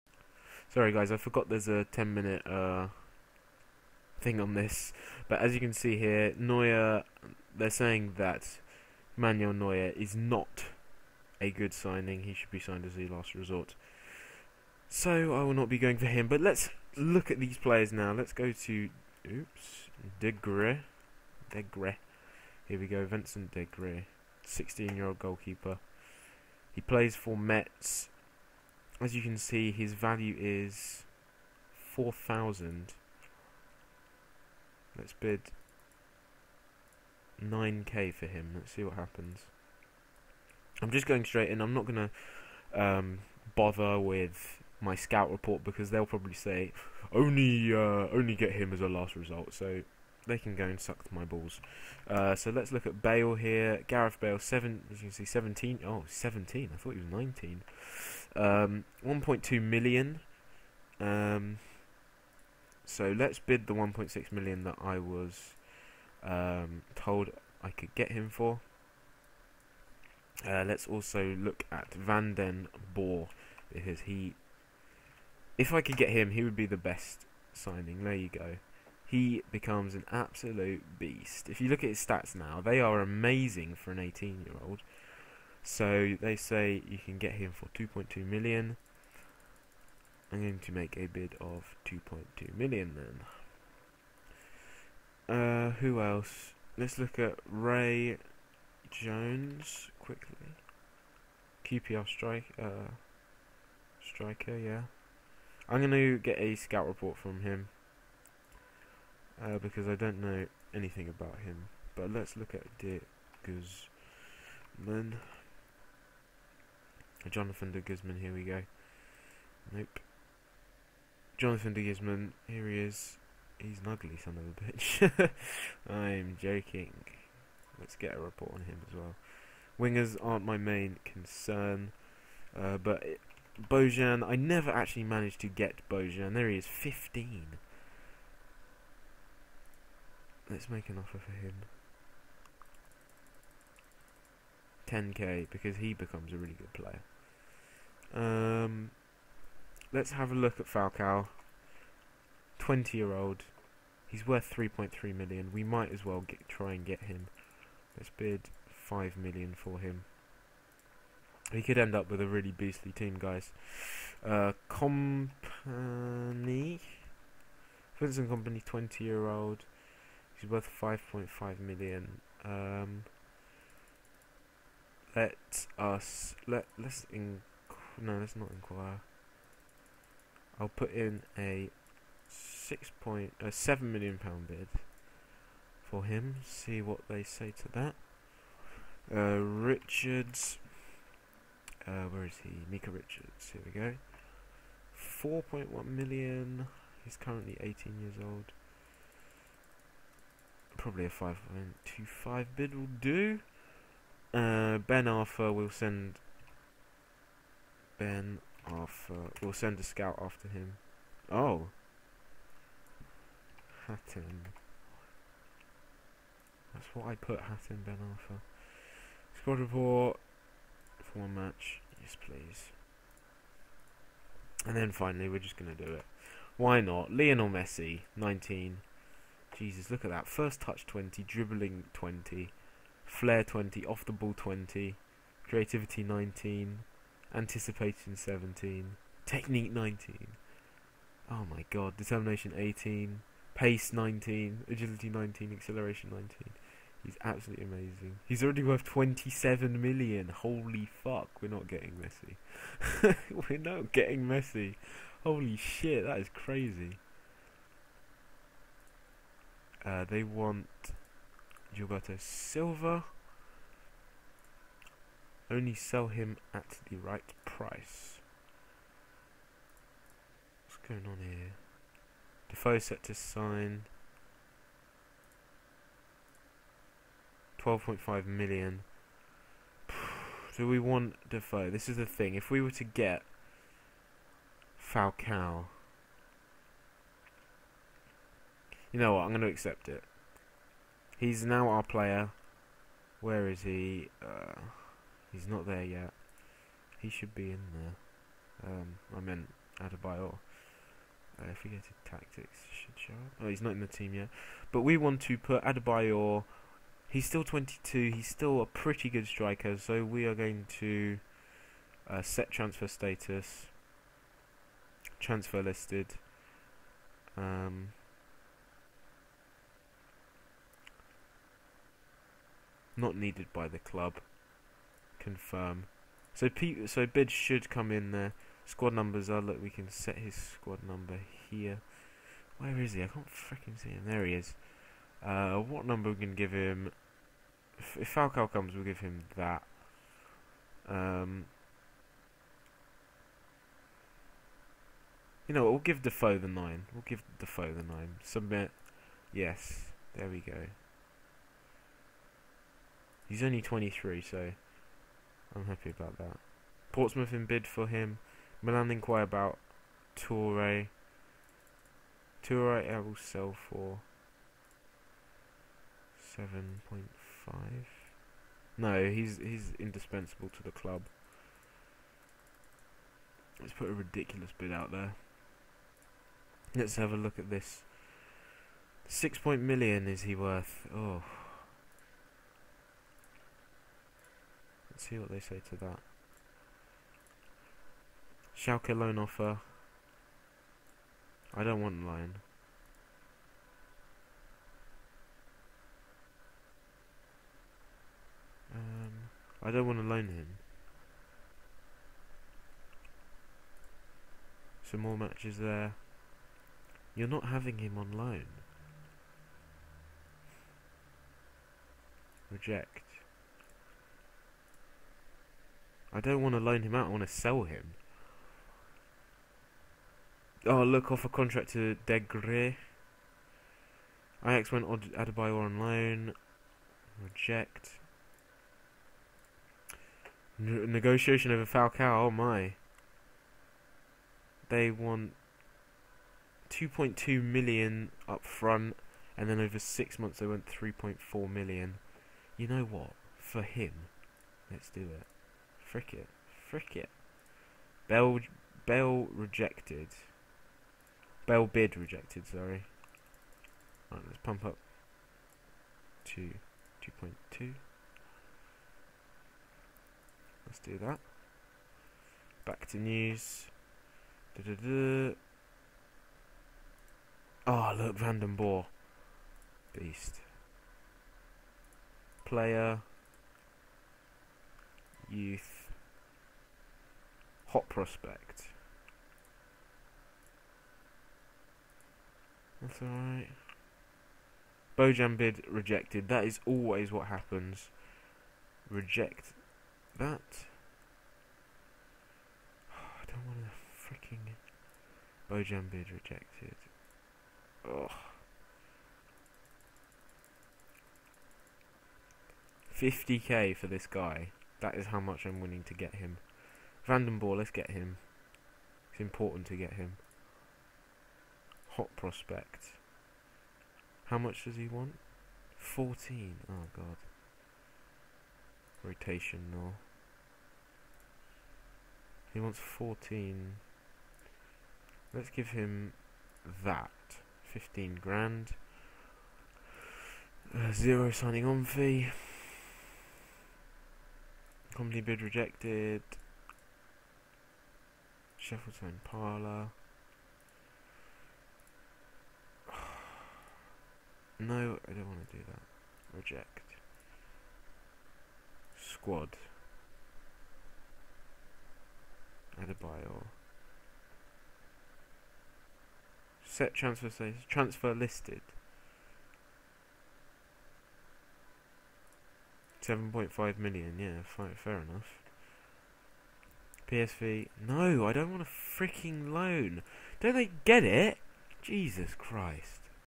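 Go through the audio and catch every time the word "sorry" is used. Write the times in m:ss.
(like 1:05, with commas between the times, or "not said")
0:00, 7:32.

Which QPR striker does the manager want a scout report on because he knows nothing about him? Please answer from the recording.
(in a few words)
Ray Jones.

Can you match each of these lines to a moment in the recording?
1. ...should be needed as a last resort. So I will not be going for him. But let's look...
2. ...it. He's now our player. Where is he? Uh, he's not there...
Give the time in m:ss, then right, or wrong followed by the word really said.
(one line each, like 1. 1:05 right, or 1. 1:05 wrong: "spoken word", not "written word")
1. 0:12 wrong: "signed", not "needed"
2. 4:49 right.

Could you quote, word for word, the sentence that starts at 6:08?
No, he's he's indispensable to the club.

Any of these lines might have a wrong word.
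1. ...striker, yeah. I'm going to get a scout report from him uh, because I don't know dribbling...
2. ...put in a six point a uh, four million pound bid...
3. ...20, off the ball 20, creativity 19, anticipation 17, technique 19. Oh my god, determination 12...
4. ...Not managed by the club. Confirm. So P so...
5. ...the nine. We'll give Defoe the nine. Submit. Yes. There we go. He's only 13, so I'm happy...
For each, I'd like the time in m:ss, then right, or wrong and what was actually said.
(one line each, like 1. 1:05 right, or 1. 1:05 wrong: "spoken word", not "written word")
1. 1:44 wrong: "anything", not "dribbling"
2. 3:00 wrong: "seven", not "four"
3. 3:53 wrong: "18", not "12"
4. 5:22 wrong: "needed", not "managed"
5. 5:46 wrong: "23", not "13".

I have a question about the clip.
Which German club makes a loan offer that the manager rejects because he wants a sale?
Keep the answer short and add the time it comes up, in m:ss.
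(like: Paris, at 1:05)
Schalke, at 6:28.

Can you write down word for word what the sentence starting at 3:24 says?
Uh, Ben Arfa will send Ben Arfa will send a scout after him.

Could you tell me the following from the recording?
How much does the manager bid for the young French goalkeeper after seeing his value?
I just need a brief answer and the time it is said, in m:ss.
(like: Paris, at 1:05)
9k, at 0:37.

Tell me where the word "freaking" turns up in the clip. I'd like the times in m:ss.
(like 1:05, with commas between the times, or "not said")
5:33, 8:14, 9:28.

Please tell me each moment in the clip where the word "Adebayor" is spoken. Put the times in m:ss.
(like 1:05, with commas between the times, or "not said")
4:59, 5:05, 7:04, 9:12.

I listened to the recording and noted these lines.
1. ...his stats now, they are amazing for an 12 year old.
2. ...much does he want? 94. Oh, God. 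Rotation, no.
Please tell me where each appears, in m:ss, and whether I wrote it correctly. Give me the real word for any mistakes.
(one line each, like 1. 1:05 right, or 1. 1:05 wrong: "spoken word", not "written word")
1. 1:21 wrong: "18", not "12"
2. 8:34 wrong: "14", not "94".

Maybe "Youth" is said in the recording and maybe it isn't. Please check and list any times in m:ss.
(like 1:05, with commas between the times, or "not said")
7:55.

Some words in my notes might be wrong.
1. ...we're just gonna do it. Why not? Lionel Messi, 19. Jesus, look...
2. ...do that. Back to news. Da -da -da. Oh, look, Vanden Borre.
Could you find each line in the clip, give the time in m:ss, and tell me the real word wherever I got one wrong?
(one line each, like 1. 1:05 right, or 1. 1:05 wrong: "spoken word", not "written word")
1. 3:45 right
2. 7:40 right.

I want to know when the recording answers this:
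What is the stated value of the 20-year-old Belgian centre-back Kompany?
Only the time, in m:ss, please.
2:50.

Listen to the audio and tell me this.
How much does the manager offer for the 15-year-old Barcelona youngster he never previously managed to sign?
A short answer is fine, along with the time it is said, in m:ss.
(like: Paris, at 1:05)
10k, at 2:24.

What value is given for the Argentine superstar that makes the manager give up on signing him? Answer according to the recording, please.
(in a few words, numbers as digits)
27 million.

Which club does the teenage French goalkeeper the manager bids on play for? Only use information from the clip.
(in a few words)
Metz.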